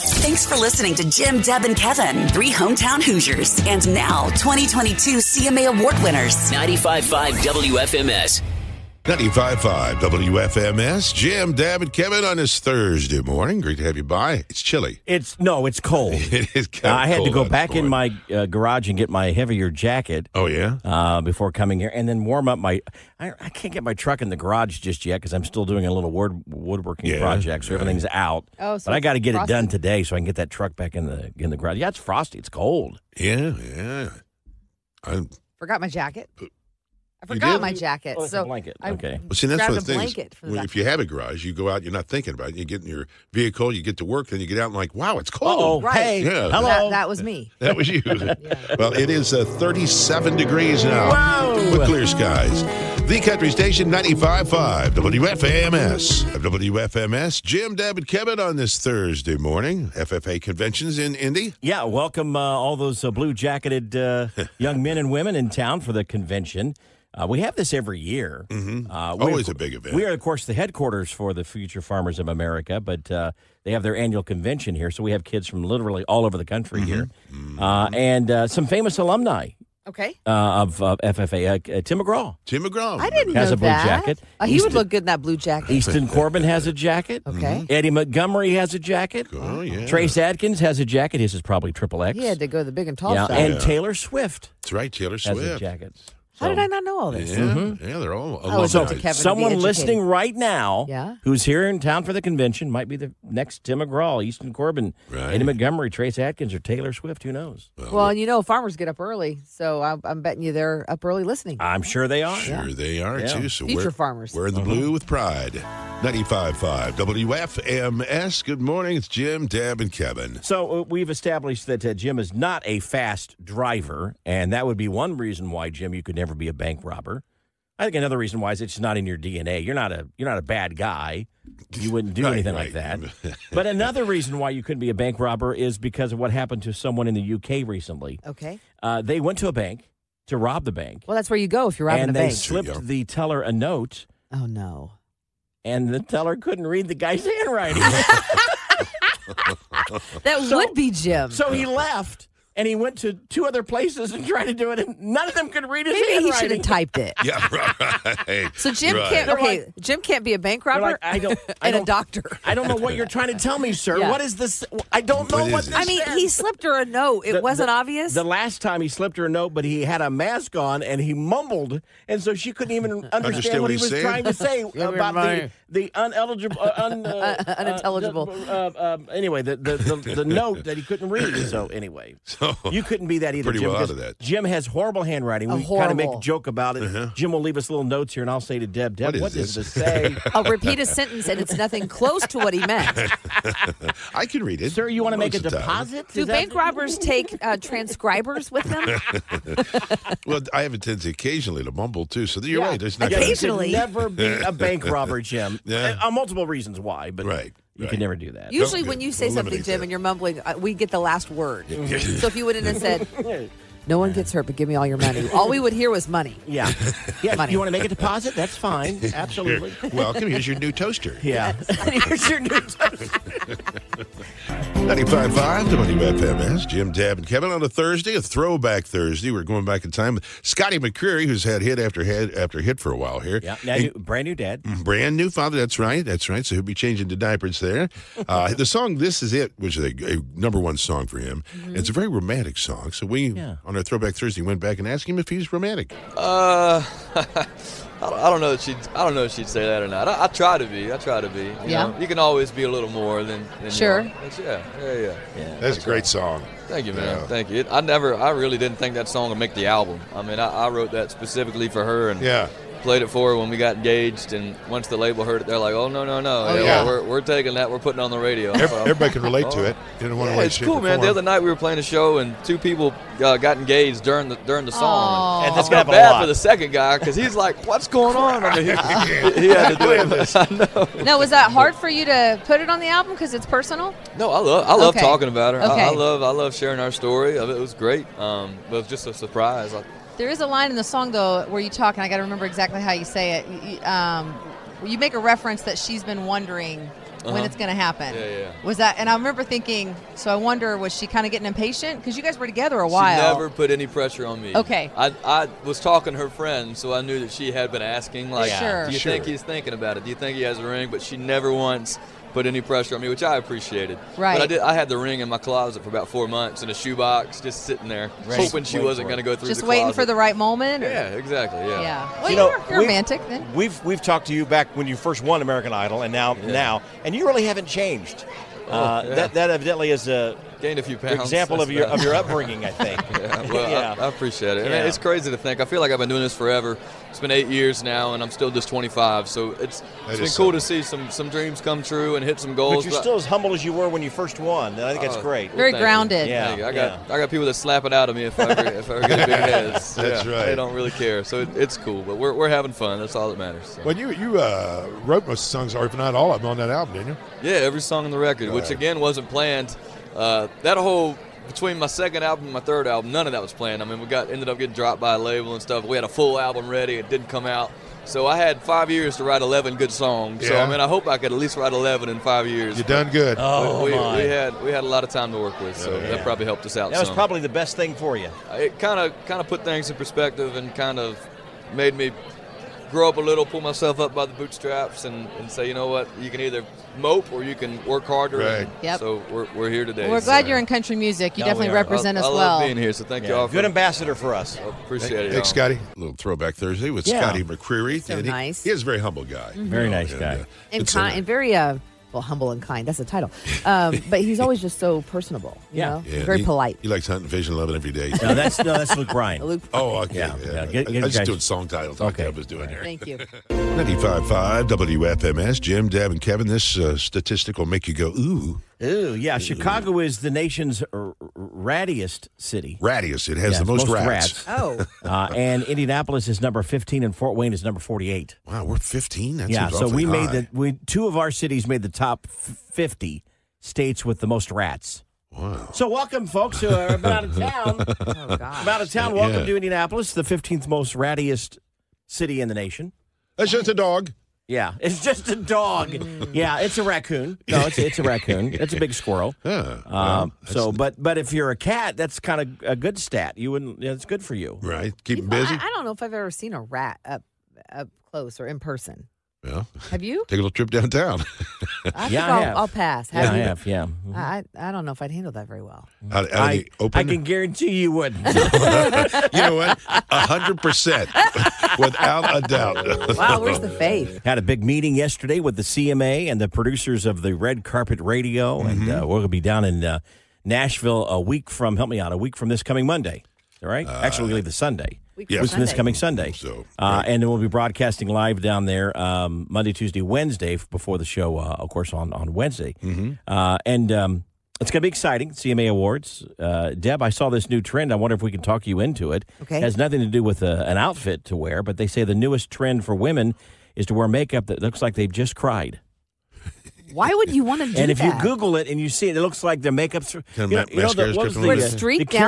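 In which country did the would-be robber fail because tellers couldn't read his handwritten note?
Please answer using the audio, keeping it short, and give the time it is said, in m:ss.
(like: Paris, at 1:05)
UK, at 2:17.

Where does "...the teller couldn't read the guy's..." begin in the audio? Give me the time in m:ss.
2:25.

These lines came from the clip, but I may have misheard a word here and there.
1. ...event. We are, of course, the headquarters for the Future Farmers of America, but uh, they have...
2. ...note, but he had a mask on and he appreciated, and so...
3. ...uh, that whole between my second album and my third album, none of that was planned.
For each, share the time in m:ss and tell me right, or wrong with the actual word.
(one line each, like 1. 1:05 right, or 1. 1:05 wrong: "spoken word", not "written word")
1. 1:09 right
2. 2:49 wrong: "mumbled", not "appreciated"
3. 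6:00 right.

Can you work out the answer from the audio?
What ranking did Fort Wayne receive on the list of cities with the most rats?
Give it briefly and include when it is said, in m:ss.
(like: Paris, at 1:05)
48, at 7:07.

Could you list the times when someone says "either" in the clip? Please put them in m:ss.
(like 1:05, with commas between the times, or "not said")
3:03, 6:26.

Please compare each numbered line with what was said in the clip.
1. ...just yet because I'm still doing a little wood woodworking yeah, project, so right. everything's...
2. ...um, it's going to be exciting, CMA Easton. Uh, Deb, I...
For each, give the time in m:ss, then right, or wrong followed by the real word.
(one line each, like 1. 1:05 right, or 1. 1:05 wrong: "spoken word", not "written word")
1. 0:24 right
2. 8:13 wrong: "Awards", not "Easton".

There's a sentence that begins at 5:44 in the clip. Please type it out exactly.
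And I think uh, that's oh, great.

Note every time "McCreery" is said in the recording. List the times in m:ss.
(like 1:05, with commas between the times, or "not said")
3:50, 6:37.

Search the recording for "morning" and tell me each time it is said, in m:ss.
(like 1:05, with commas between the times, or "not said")
0:13, 0:59, 1:58.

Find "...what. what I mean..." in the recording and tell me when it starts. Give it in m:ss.
2:45.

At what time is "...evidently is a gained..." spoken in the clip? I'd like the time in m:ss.
5:29.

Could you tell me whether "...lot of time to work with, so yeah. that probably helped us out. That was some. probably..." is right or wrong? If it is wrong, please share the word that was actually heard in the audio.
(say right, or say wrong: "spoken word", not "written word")
right.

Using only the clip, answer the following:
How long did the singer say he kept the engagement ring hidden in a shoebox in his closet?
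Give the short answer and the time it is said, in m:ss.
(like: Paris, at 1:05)
About four months, at 5:15.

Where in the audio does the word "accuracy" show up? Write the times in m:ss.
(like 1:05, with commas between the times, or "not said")
not said.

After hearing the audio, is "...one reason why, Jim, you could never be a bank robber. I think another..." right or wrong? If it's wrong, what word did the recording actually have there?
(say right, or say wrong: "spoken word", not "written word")
right.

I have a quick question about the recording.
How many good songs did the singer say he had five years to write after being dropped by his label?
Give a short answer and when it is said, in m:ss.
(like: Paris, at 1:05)
11, at 6:09.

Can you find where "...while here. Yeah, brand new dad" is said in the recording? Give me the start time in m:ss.
3:52.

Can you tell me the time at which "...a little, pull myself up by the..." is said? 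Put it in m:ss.
6:23.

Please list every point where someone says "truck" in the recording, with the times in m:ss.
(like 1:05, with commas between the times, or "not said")
0:23, 0:30.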